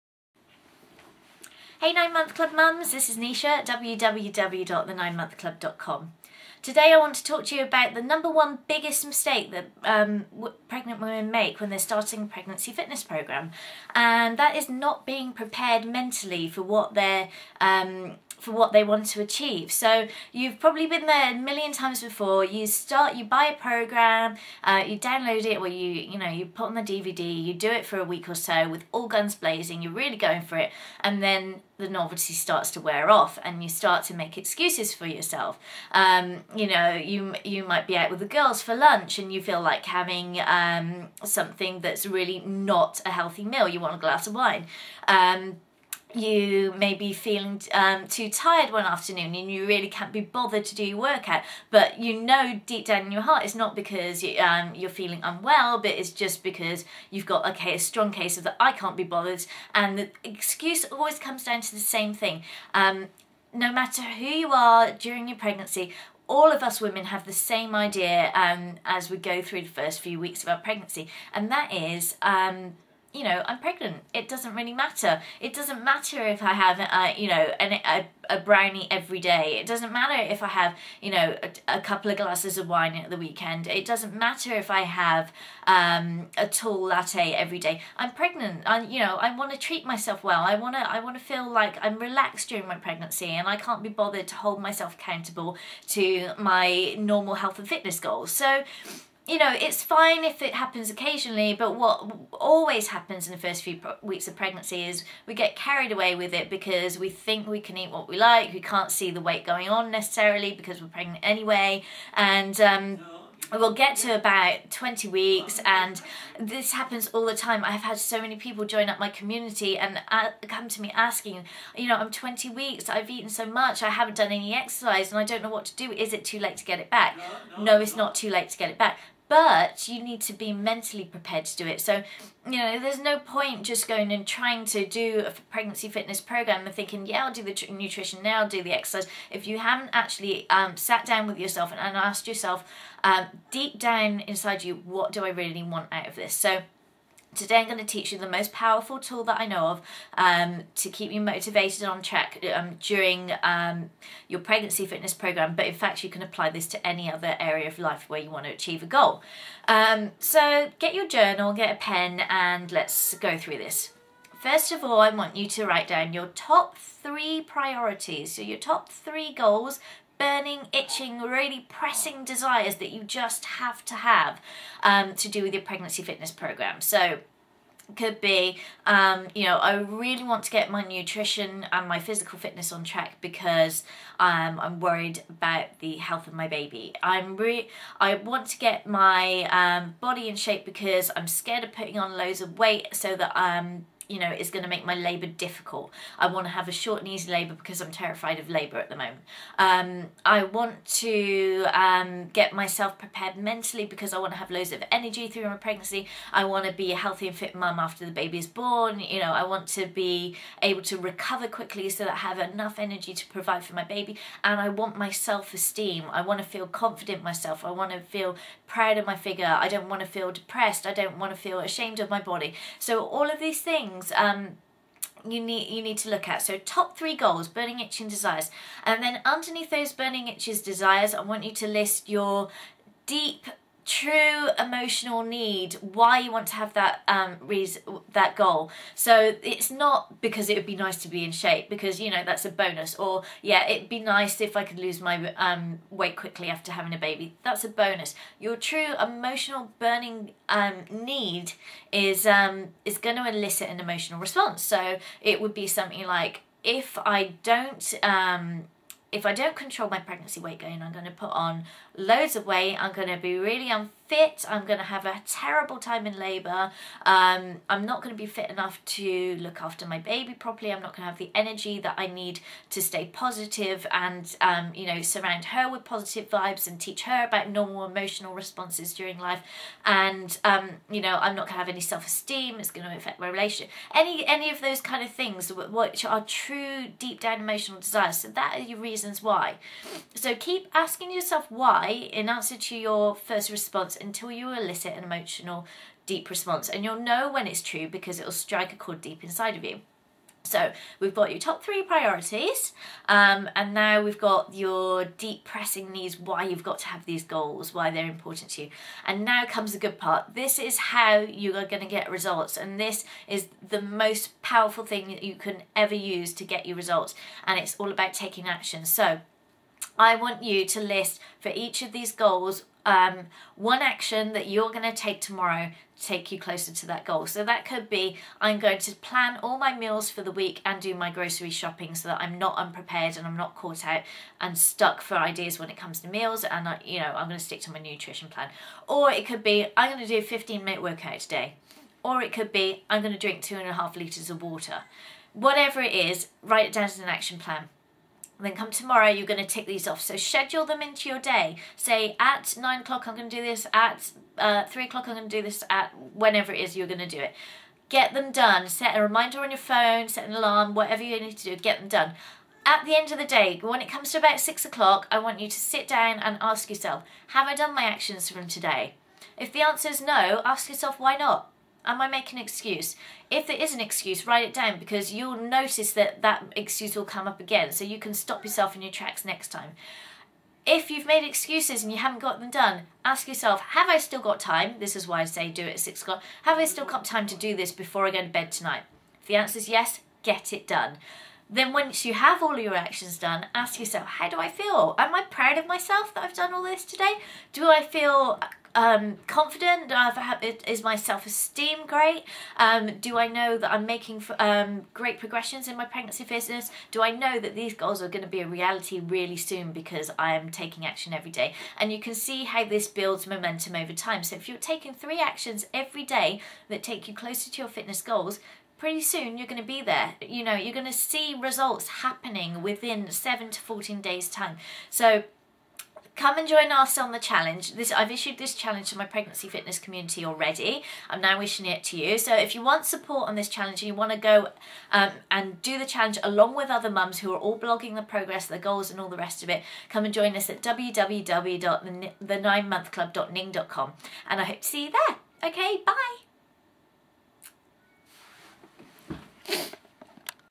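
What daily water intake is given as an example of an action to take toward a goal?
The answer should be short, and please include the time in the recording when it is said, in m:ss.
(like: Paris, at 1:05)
2.5 litres, at 5:43.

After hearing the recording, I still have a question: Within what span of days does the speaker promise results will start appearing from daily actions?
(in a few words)
7 to 14 days.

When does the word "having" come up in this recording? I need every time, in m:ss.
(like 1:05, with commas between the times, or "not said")
0:39, 4:06.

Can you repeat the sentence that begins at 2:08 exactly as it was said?
not too late to get it back but you need to be mentally prepared to do it.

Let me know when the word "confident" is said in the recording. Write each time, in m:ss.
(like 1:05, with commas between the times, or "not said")
3:36, 6:39.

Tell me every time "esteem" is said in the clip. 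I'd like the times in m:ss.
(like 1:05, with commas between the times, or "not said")
3:35, 4:41, 6:40.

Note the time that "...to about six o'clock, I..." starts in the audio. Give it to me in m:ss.
6:04.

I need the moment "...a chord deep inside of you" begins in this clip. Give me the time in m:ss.
4:58.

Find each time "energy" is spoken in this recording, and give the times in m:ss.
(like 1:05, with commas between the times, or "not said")
3:24, 3:32, 4:31.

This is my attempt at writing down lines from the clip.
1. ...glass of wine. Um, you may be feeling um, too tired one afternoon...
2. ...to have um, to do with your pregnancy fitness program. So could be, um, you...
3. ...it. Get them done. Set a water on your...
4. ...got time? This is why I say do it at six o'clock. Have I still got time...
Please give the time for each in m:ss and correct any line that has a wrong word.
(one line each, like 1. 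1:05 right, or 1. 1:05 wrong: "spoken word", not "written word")
1. 0:43 right
2. 2:53 right
3. 5:57 wrong: "reminder", not "water"
4. 6:24 right.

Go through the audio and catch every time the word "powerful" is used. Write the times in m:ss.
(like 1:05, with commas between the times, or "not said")
2:28, 5:14.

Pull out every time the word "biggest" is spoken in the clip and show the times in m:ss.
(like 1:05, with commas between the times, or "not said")
0:08.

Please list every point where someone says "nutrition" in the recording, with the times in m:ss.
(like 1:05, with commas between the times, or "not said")
2:17, 3:00, 5:37.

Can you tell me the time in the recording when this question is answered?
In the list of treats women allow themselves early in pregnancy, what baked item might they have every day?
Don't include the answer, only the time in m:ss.
1:18.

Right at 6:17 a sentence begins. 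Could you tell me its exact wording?
So you can stop yourself in your tracks next time.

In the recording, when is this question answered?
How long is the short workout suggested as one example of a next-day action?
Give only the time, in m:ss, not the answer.
5:40.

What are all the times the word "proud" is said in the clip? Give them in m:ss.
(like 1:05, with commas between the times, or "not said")
3:38, 6:35.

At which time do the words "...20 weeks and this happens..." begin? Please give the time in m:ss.
1:54.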